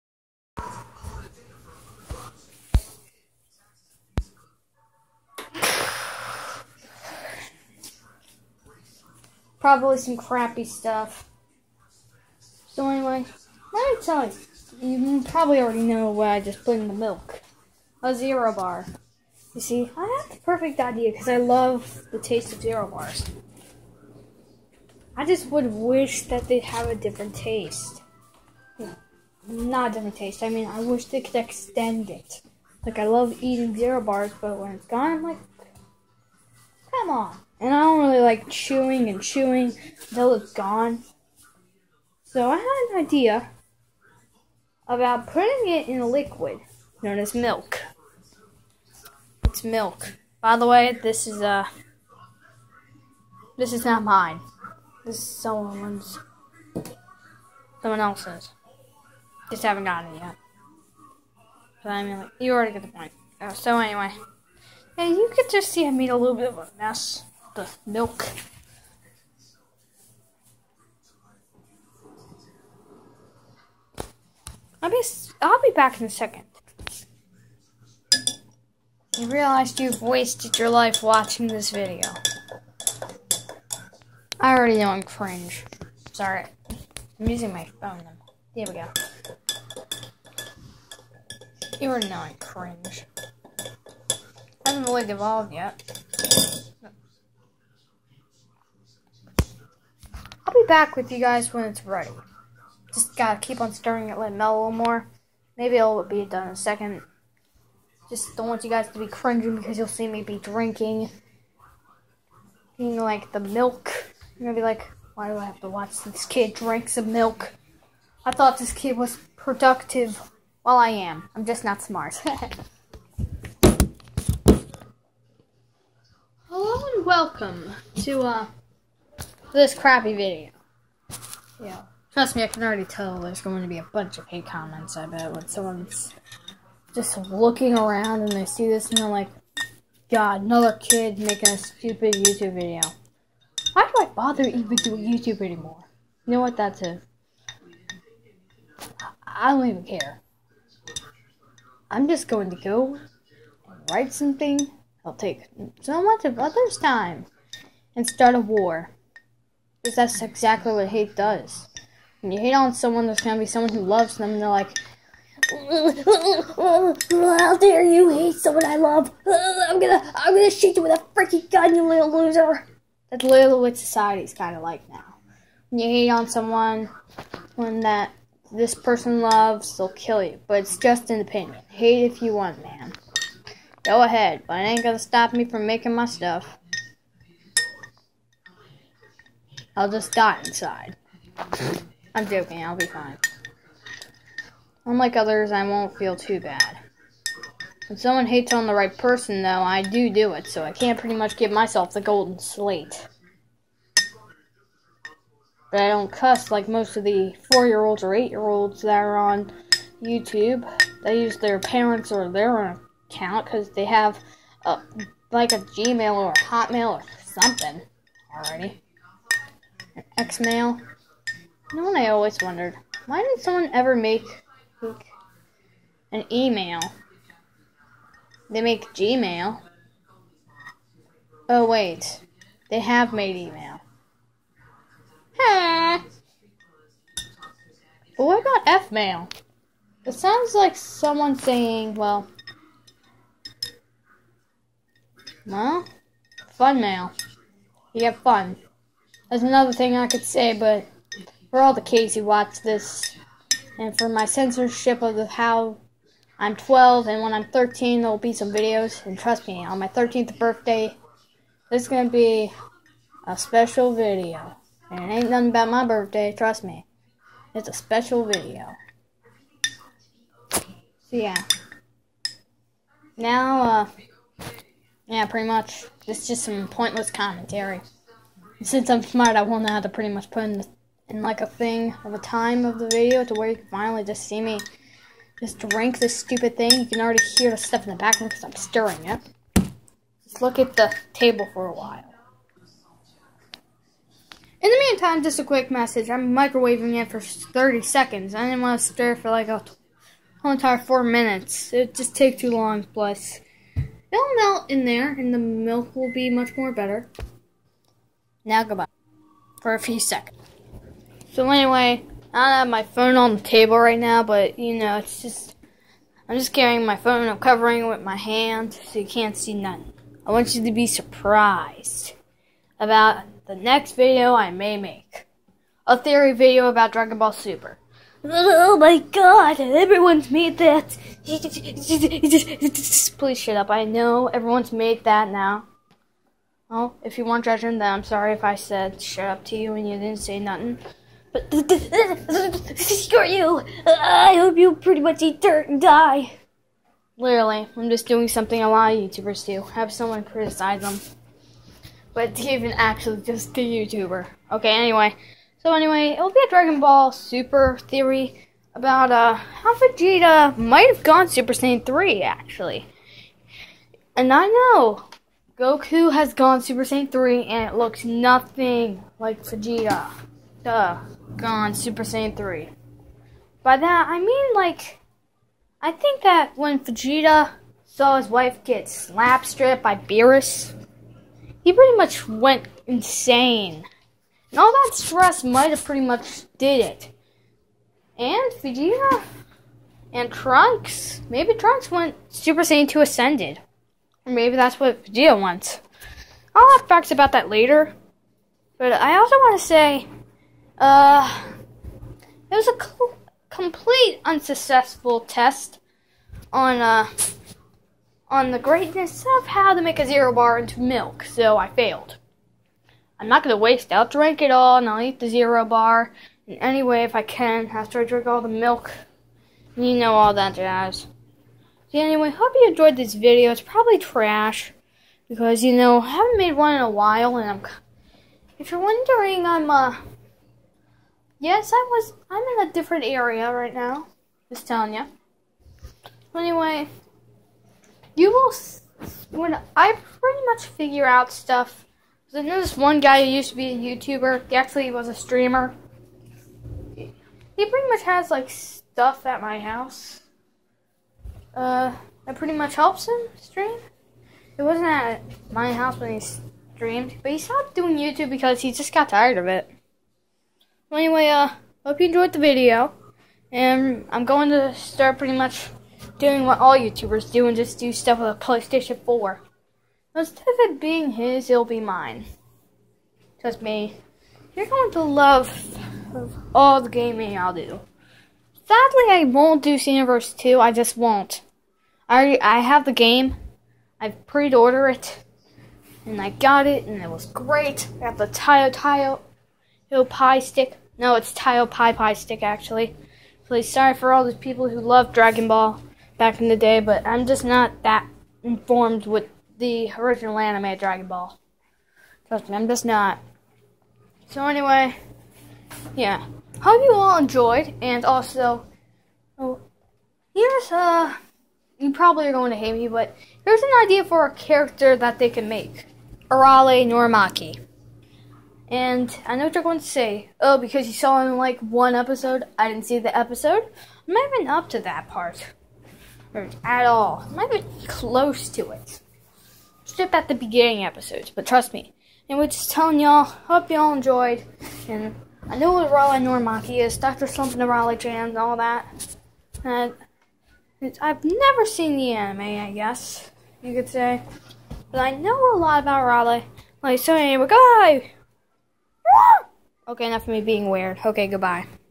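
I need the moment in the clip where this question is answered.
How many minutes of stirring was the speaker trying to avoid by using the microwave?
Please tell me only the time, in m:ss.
5:00.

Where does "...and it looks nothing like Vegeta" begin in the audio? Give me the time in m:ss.
6:07.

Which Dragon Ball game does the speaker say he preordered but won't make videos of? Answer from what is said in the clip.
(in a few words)
Xenoverse 2.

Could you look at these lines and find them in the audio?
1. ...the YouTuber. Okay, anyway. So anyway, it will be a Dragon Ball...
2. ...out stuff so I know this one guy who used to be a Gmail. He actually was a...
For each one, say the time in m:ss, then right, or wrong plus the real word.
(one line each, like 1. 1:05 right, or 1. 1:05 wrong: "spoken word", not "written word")
1. 5:53 right
2. 7:21 wrong: "YouTuber", not "Gmail".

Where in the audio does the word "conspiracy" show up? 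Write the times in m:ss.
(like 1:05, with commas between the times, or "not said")
not said.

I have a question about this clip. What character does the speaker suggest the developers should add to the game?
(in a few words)
Arale Norimaki.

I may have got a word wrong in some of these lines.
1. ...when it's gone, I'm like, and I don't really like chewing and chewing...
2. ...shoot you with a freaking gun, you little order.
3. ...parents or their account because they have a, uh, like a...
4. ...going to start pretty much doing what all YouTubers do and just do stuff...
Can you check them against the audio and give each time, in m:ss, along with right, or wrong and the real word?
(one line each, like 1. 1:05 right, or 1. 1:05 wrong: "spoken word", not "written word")
1. 0:34 right
2. 2:50 wrong: "loser", not "order"
3. 3:31 right
4. 7:44 right.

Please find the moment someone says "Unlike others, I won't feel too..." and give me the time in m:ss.
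3:14.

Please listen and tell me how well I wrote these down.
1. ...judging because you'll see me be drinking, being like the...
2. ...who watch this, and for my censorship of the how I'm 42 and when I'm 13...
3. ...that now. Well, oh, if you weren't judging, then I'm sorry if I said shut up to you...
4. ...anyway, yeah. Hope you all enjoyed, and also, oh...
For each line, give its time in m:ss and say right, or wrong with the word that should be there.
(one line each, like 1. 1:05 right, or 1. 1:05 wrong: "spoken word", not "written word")
1. 1:49 wrong: "cringing", not "judging"
2. 4:12 wrong: "12", not "42"
3. 5:35 right
4. 8:24 right.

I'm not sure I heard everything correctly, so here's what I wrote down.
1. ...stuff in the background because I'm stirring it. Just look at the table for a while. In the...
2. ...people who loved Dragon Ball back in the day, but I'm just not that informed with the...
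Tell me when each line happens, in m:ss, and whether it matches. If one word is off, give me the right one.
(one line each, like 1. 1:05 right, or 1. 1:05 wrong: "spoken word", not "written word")
1. 4:47 right
2. 8:14 right.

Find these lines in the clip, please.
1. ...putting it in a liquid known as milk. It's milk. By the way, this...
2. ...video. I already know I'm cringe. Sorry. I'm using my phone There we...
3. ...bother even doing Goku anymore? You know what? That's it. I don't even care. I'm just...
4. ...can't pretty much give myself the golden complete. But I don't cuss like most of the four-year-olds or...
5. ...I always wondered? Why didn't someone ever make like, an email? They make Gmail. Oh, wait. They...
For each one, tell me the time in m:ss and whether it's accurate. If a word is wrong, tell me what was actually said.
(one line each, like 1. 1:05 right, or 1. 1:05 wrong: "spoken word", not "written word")
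1. 0:45 right
2. 1:21 right
3. 2:24 wrong: "YouTube", not "Goku"
4. 3:20 wrong: "slate", not "complete"
5. 3:41 right.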